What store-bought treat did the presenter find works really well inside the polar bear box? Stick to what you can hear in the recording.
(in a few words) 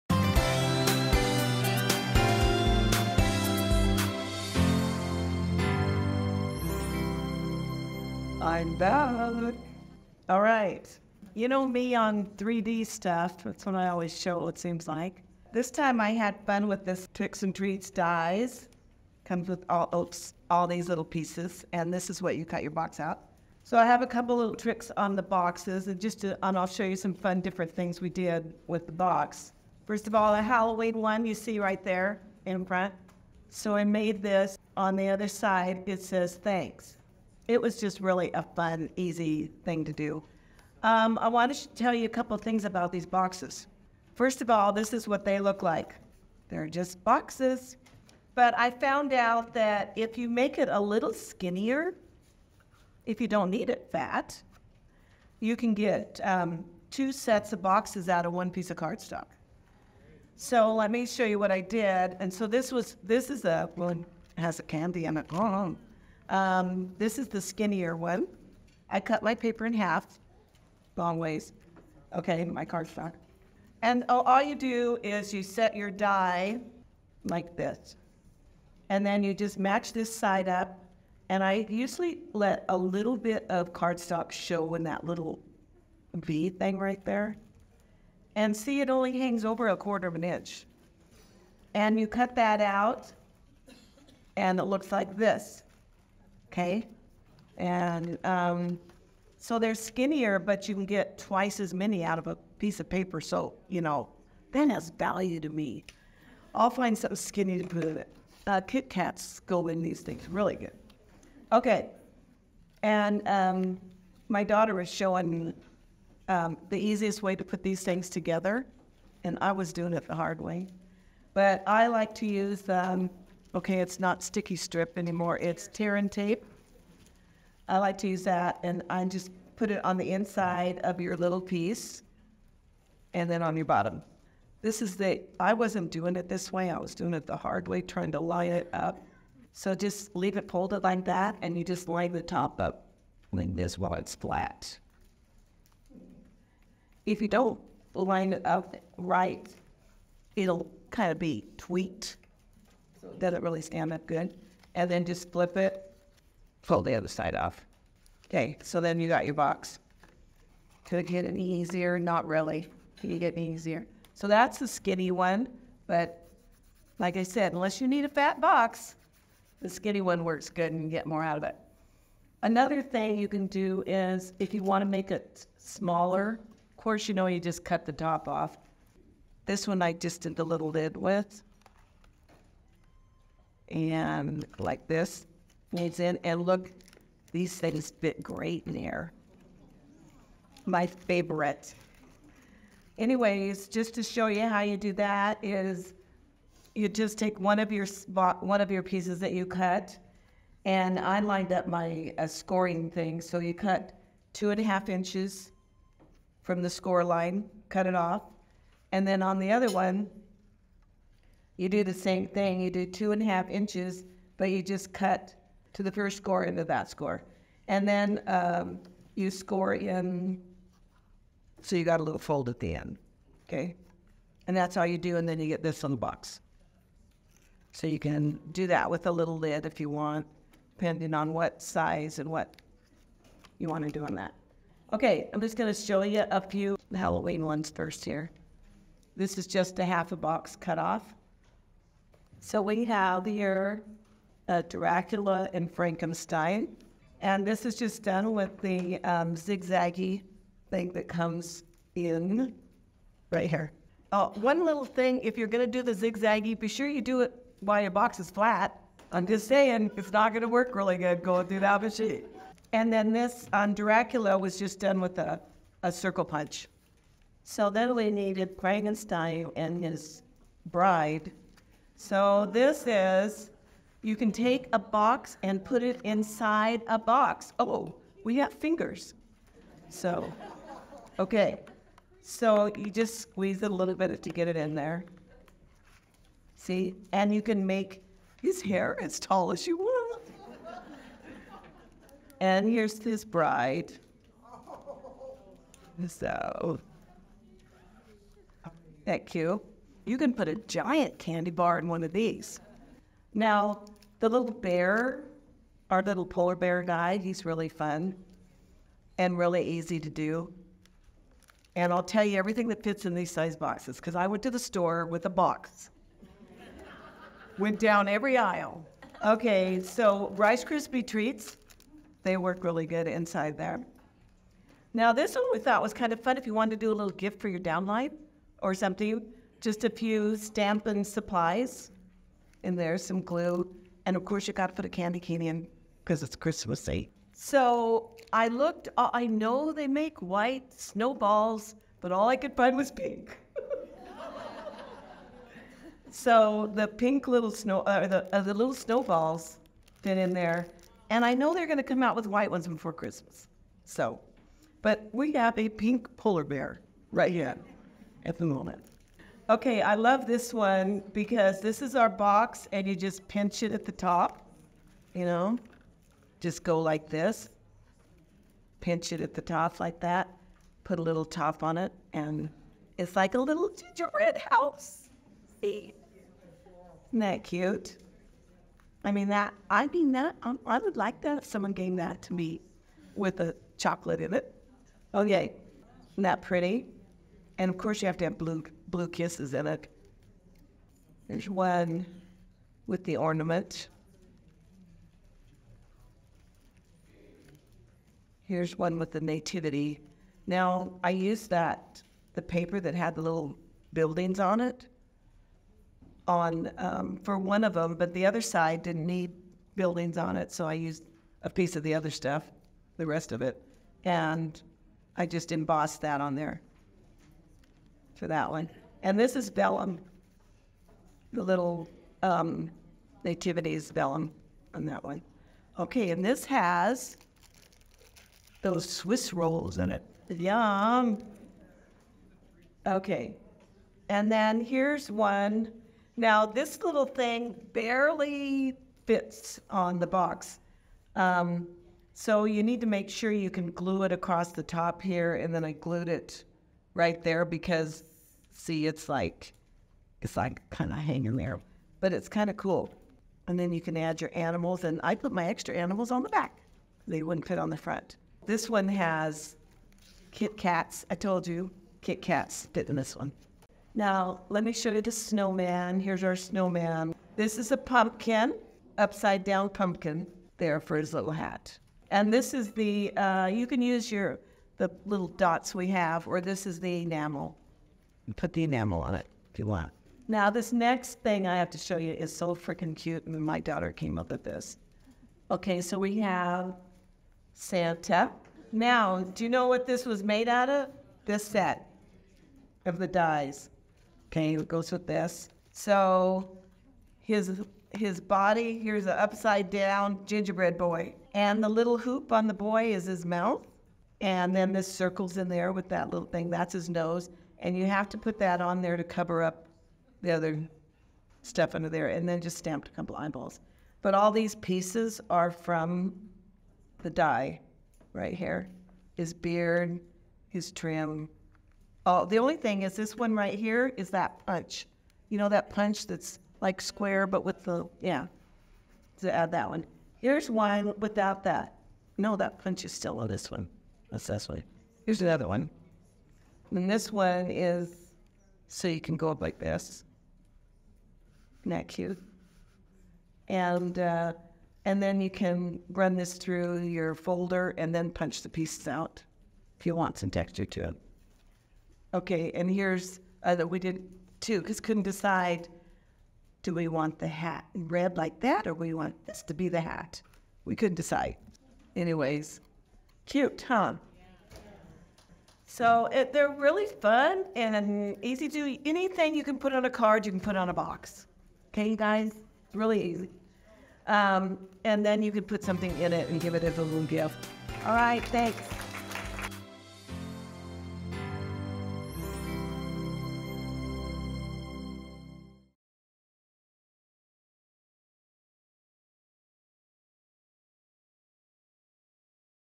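Rice Krispie treats.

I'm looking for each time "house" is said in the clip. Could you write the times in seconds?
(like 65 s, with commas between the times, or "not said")
374 s.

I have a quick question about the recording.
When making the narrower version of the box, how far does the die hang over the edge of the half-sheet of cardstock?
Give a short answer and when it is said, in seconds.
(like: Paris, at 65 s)
A quarter of an inch, at 89 s.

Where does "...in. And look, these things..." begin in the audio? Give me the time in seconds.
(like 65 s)
185 s.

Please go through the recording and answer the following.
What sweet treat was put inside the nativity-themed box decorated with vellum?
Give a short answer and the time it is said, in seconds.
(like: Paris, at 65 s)
Swiss rolls, at 428 s.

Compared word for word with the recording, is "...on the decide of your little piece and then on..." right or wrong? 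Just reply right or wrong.
wrong.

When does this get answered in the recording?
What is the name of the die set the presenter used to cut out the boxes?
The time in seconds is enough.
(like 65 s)
17 s.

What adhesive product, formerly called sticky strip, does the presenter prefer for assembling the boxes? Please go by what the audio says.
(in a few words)
Tear and tape.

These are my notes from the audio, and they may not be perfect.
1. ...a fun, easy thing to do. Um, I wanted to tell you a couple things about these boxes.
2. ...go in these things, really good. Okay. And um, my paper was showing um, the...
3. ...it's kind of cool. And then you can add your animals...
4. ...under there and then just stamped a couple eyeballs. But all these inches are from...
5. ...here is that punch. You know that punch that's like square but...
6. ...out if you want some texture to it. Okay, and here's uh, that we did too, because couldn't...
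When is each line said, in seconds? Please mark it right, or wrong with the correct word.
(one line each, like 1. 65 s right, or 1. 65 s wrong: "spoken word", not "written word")
1. 38 s right
2. 109 s wrong: "daughter", not "paper"
3. 452 s right
4. 511 s wrong: "pieces", not "inches"
5. 523 s right
6. 548 s right.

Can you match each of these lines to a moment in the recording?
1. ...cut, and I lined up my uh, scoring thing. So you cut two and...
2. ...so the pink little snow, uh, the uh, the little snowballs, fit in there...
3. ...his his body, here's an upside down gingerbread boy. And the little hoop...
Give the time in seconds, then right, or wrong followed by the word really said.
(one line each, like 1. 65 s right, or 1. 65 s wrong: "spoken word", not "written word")
1. 199 s right
2. 346 s right
3. 497 s right.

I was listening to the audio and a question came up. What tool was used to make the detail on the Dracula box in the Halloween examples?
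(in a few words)
A circle punch.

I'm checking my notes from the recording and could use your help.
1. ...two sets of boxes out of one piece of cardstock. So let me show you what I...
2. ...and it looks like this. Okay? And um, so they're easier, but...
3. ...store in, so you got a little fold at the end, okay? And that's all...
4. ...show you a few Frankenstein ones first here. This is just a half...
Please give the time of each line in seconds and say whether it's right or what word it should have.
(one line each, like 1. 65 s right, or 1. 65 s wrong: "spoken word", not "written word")
1. 56 s right
2. 94 s wrong: "skinnier", not "easier"
3. 219 s wrong: "score", not "store"
4. 235 s wrong: "Halloween", not "Frankenstein".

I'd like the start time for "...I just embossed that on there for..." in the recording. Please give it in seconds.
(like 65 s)
415 s.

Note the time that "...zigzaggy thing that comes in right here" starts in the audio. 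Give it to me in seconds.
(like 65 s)
249 s.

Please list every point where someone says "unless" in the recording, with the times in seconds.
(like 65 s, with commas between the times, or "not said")
167 s.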